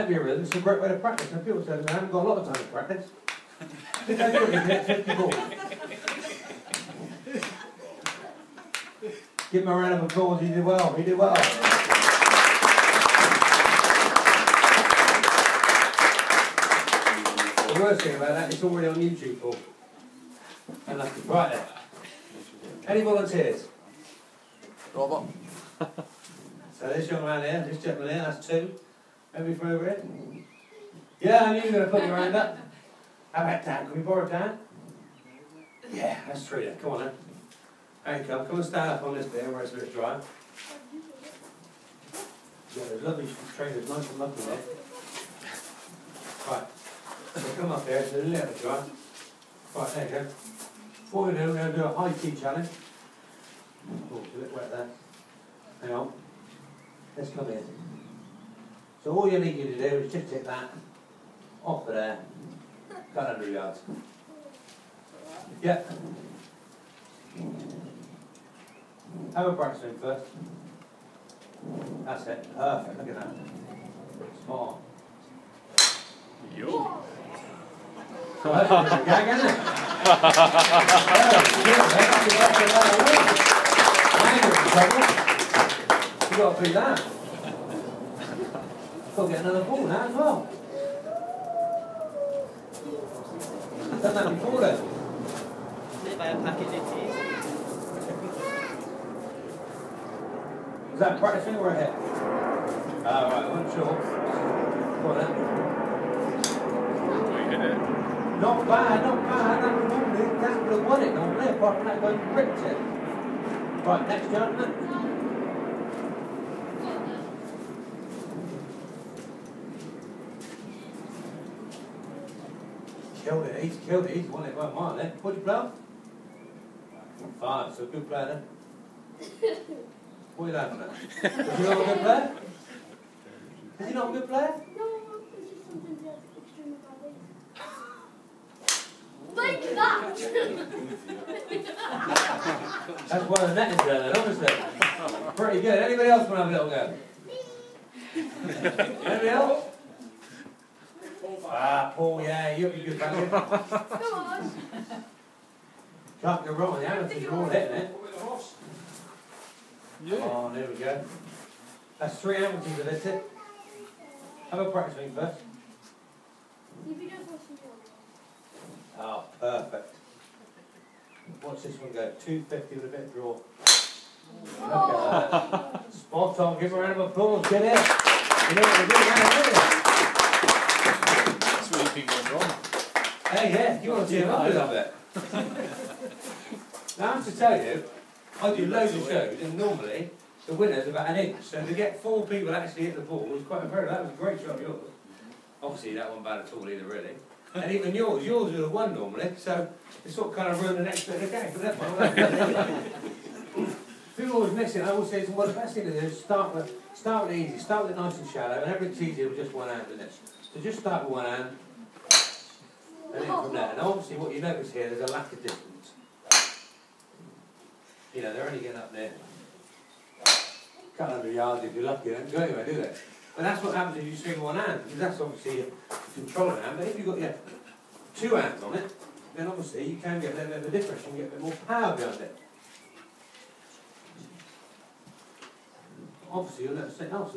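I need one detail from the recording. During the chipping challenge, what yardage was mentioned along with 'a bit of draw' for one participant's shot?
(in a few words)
250.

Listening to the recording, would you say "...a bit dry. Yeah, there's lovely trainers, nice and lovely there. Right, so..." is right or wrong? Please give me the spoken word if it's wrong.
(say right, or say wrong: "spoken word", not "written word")
right.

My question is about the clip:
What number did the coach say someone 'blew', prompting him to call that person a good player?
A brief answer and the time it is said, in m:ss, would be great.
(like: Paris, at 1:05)
5, at 2:07.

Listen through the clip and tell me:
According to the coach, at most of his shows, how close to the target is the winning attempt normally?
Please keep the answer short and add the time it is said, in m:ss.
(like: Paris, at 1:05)
about an inch, at 3:10.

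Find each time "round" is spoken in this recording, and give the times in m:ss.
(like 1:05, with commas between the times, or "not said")
0:09, 2:56.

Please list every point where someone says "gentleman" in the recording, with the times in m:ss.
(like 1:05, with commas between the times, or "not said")
0:27, 1:54.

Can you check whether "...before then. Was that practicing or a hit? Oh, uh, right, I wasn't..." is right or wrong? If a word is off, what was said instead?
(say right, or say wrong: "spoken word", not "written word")
right.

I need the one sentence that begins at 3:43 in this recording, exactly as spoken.
And that's what happens if you swing one hand, because that's obviously a controlling hand.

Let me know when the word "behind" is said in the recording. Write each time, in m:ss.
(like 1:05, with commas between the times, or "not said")
3:51.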